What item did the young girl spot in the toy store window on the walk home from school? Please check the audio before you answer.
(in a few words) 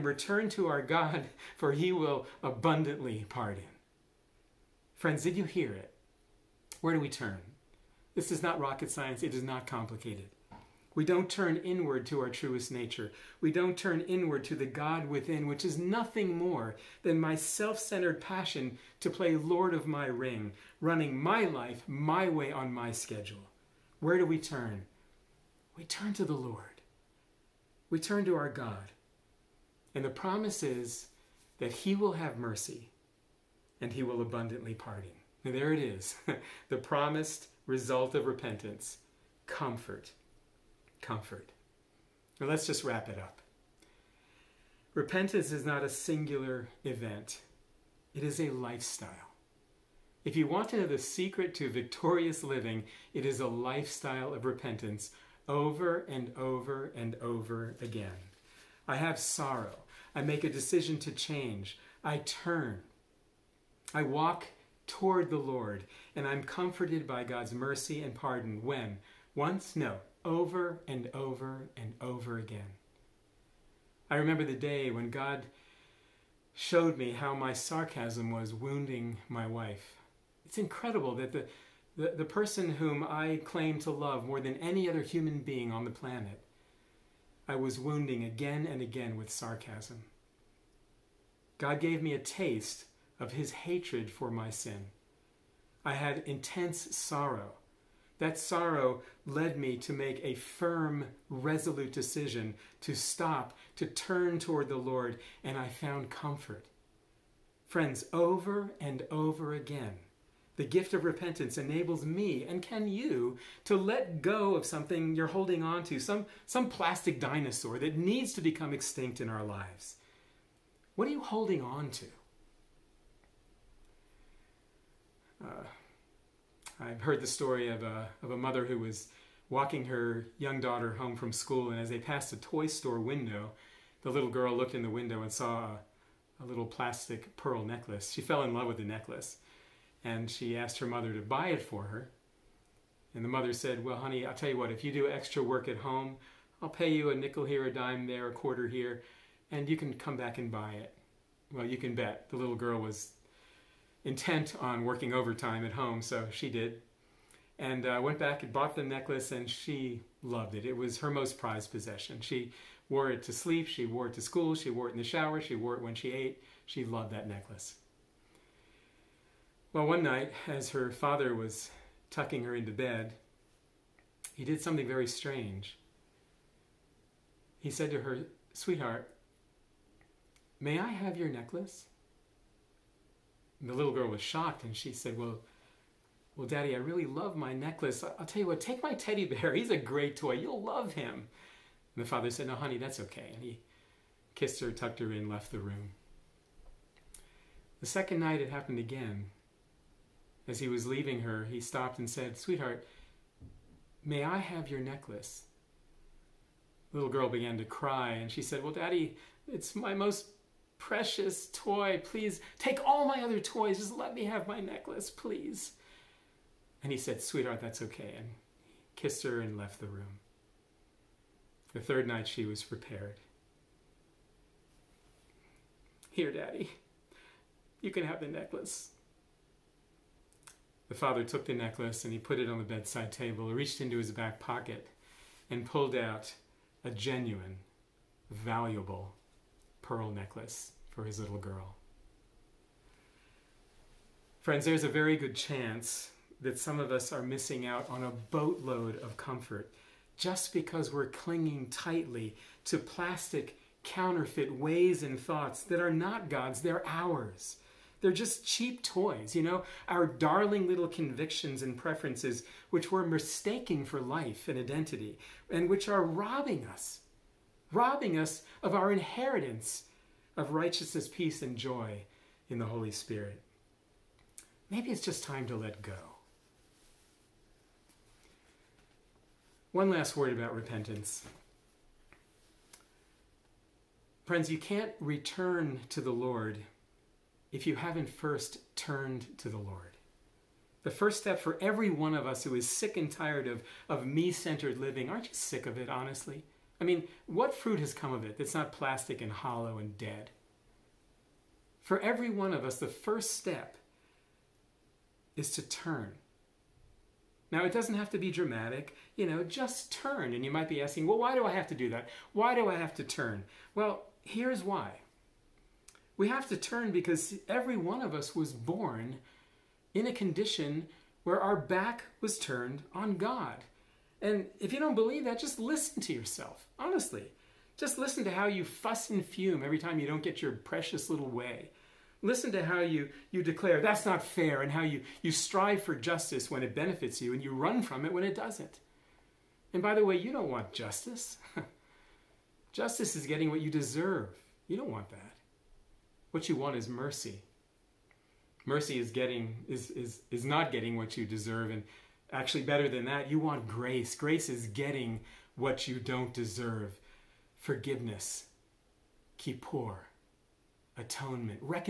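Plastic pearl necklace.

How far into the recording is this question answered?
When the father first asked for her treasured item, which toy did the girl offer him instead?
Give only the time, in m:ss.
3:08.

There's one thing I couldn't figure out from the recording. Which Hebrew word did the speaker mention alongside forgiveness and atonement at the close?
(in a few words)
Kippur.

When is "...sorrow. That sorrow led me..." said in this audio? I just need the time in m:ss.
1:36.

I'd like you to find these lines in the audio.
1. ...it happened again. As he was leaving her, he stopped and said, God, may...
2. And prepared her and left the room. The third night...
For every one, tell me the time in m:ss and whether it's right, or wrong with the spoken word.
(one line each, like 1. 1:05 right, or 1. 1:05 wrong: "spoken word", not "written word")
1. 3:18 wrong: "Sweetheart", not "God"
2. 3:38 wrong: "kissed", not "prepared".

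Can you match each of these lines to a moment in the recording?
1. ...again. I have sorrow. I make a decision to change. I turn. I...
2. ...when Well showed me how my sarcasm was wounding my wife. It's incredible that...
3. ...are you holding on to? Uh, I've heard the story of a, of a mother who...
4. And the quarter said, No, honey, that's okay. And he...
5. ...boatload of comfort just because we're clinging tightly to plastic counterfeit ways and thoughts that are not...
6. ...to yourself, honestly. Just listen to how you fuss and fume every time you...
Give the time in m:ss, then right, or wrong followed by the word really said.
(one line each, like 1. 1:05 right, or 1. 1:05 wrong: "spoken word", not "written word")
1. 0:57 right
2. 1:14 wrong: "God", not "Well"
3. 2:01 right
4. 3:11 wrong: "father", not "quarter"
5. 4:08 right
6. 5:26 right.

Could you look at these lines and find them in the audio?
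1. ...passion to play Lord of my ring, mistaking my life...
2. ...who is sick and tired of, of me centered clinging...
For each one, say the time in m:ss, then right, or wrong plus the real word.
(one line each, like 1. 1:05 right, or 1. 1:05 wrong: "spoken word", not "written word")
1. 0:18 wrong: "running", not "mistaking"
2. 4:52 wrong: "living", not "clinging".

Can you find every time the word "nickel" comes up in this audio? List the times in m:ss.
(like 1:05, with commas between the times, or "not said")
2:27.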